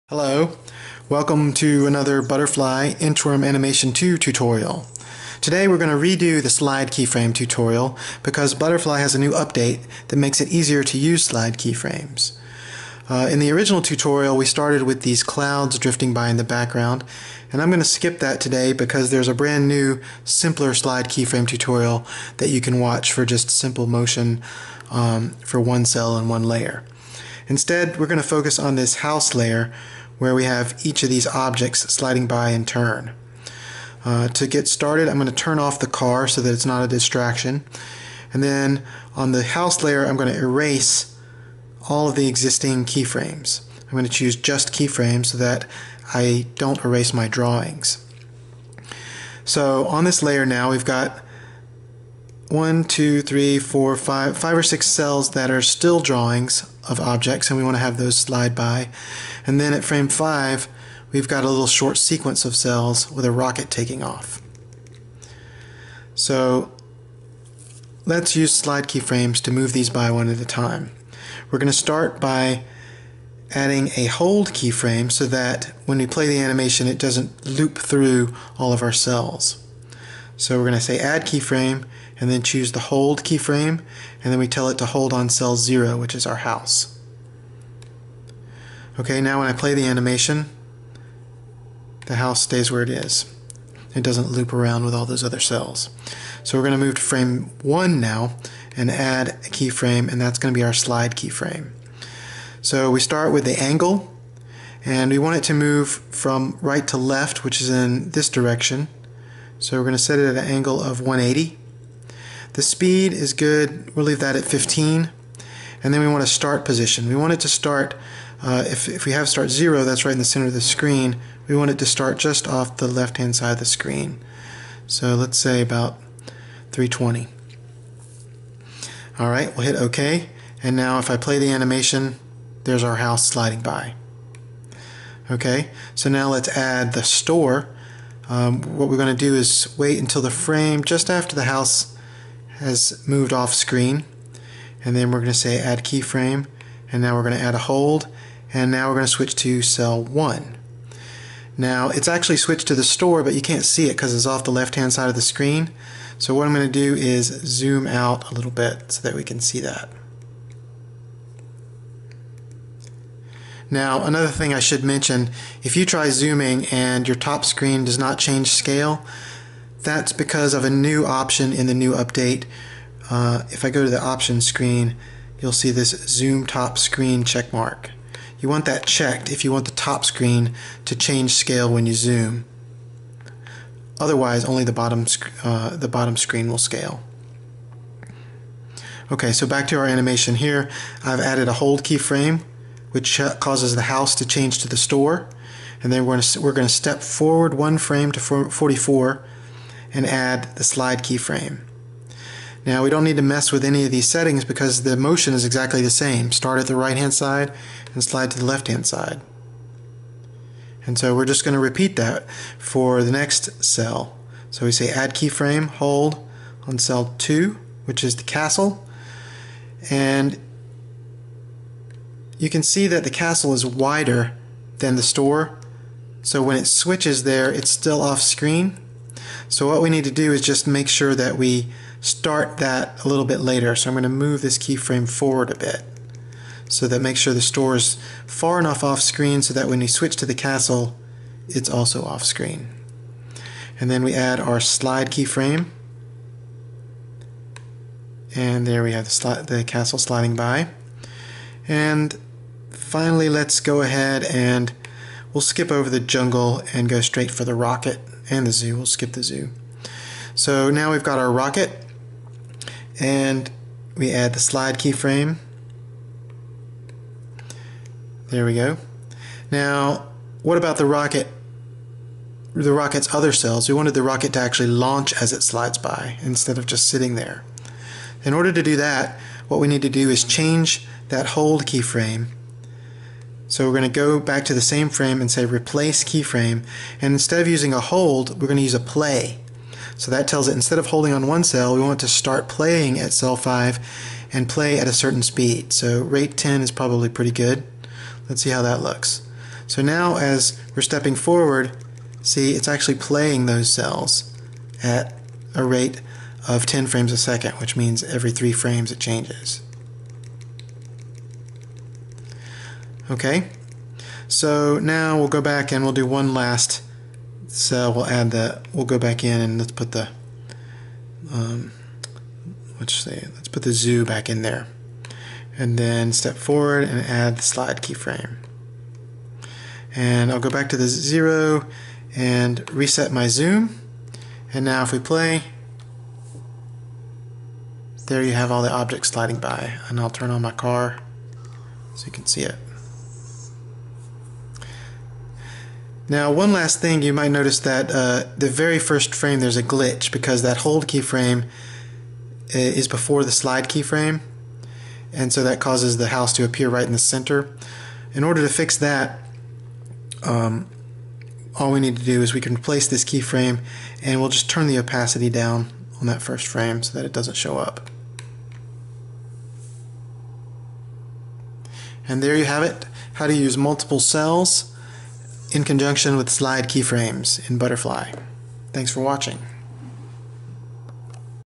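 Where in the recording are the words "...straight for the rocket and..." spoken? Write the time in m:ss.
4:17.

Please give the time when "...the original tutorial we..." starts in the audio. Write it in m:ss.
0:13.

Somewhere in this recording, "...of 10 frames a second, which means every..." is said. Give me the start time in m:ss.
5:06.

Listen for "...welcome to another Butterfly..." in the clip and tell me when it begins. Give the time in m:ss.
0:01.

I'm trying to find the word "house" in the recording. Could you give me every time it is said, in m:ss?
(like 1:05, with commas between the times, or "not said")
0:28, 0:39, 1:26, 1:32, 2:12, 2:21, 3:13, 5:56.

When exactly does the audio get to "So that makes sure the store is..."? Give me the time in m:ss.
3:56.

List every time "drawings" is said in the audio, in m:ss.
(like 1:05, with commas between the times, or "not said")
0:47, 0:55.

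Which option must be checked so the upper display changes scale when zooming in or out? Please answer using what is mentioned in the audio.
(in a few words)
zoom top screen.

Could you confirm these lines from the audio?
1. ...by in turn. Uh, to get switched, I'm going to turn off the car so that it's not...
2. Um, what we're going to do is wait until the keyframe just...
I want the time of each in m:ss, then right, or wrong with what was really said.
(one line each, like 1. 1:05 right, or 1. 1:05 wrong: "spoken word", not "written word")
1. 0:32 wrong: "started", not "switched"
2. 2:18 wrong: "frame", not "keyframe".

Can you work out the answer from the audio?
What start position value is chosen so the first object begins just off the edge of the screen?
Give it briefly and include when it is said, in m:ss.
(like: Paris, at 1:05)
320, at 2:06.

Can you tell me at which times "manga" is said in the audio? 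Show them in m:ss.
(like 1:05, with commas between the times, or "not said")
not said.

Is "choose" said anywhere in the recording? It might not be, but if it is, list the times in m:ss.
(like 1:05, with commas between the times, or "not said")
0:44, 1:22.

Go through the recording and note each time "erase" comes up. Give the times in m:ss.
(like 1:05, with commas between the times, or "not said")
0:40, 0:46.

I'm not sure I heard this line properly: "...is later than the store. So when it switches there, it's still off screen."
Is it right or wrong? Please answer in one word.
wrong.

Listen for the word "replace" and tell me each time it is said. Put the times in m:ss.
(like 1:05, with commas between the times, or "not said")
4:45, 6:02.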